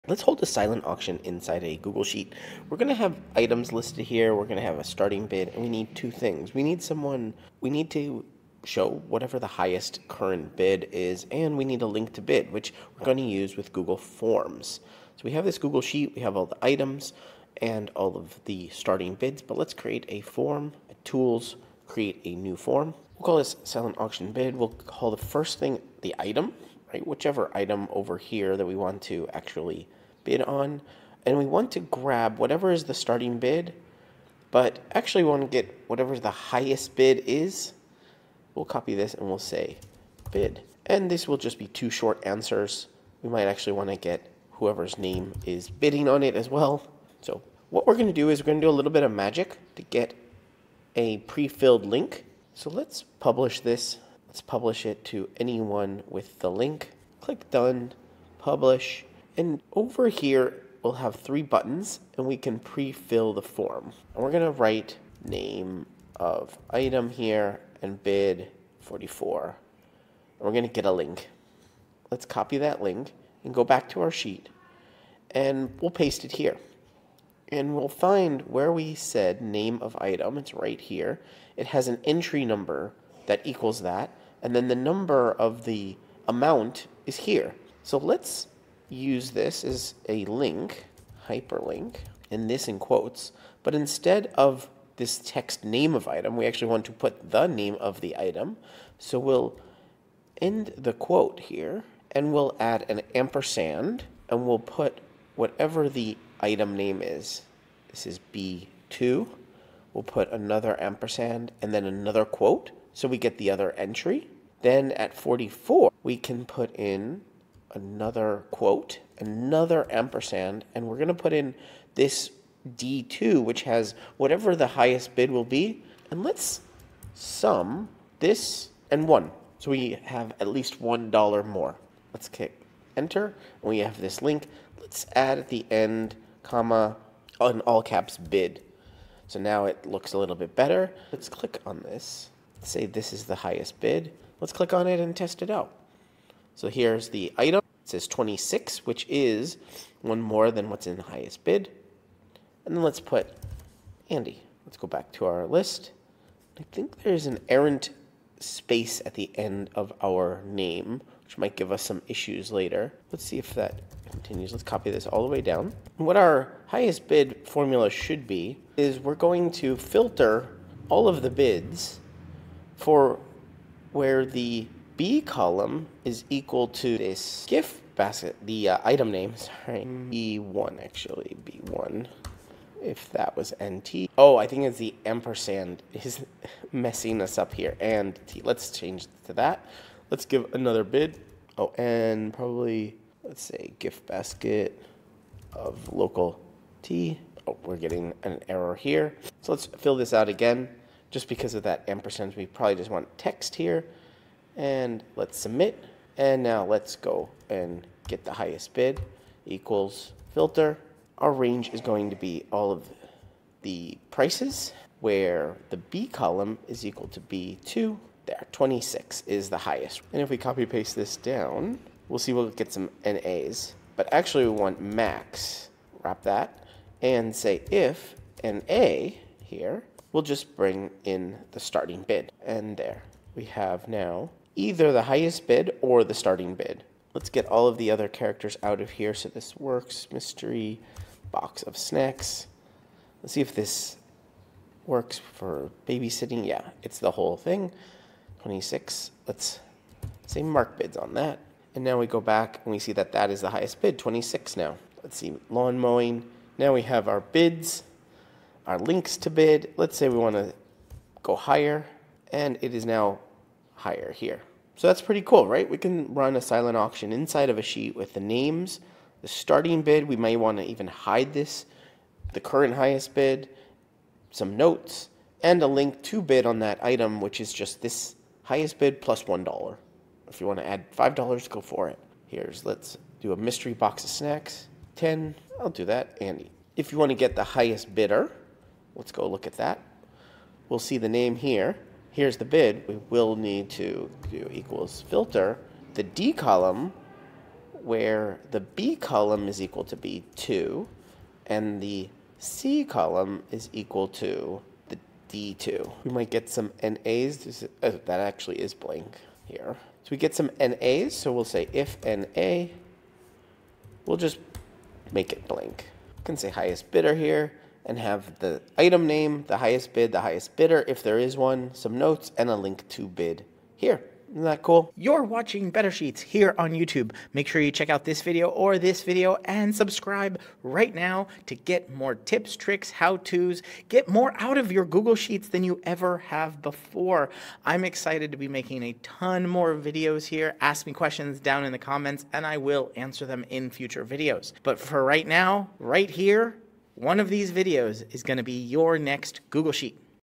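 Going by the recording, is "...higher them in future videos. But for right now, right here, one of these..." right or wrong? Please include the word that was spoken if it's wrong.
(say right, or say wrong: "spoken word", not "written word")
wrong: "answer", not "higher".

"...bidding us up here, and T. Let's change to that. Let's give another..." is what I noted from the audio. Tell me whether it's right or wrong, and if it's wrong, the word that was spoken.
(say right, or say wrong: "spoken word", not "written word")
wrong: "messing", not "bidding".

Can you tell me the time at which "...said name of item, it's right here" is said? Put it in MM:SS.
01:18.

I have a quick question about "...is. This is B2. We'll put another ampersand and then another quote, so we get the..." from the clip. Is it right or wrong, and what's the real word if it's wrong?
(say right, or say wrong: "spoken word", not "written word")
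right.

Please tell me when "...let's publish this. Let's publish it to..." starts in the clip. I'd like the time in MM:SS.
00:52.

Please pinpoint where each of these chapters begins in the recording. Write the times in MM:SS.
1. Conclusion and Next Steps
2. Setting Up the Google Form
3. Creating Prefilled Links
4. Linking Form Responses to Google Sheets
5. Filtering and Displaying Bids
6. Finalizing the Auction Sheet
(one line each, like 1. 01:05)
1. 05:24
2. 00:15
3. 00:47
4. 01:12
5. 02:45
6. 04:16.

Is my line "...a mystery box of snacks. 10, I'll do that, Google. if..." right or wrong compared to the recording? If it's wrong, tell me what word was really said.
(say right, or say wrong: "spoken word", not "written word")
wrong: "Andy", not "Google".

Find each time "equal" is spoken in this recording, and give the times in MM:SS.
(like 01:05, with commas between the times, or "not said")
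01:23, 02:56, 03:29, 03:36, 04:54, 04:59, 05:03.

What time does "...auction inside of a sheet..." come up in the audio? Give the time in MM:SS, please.
04:26.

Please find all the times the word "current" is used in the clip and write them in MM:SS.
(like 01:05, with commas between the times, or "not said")
00:10, 04:32.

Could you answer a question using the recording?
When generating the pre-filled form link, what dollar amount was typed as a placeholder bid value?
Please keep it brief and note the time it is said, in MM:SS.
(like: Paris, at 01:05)
44, at 01:08.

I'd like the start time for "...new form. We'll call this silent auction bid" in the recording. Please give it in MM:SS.
00:22.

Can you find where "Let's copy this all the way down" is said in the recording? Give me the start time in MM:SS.
02:44.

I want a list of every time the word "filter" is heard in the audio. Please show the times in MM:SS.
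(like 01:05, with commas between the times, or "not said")
02:49, 03:30, 04:55.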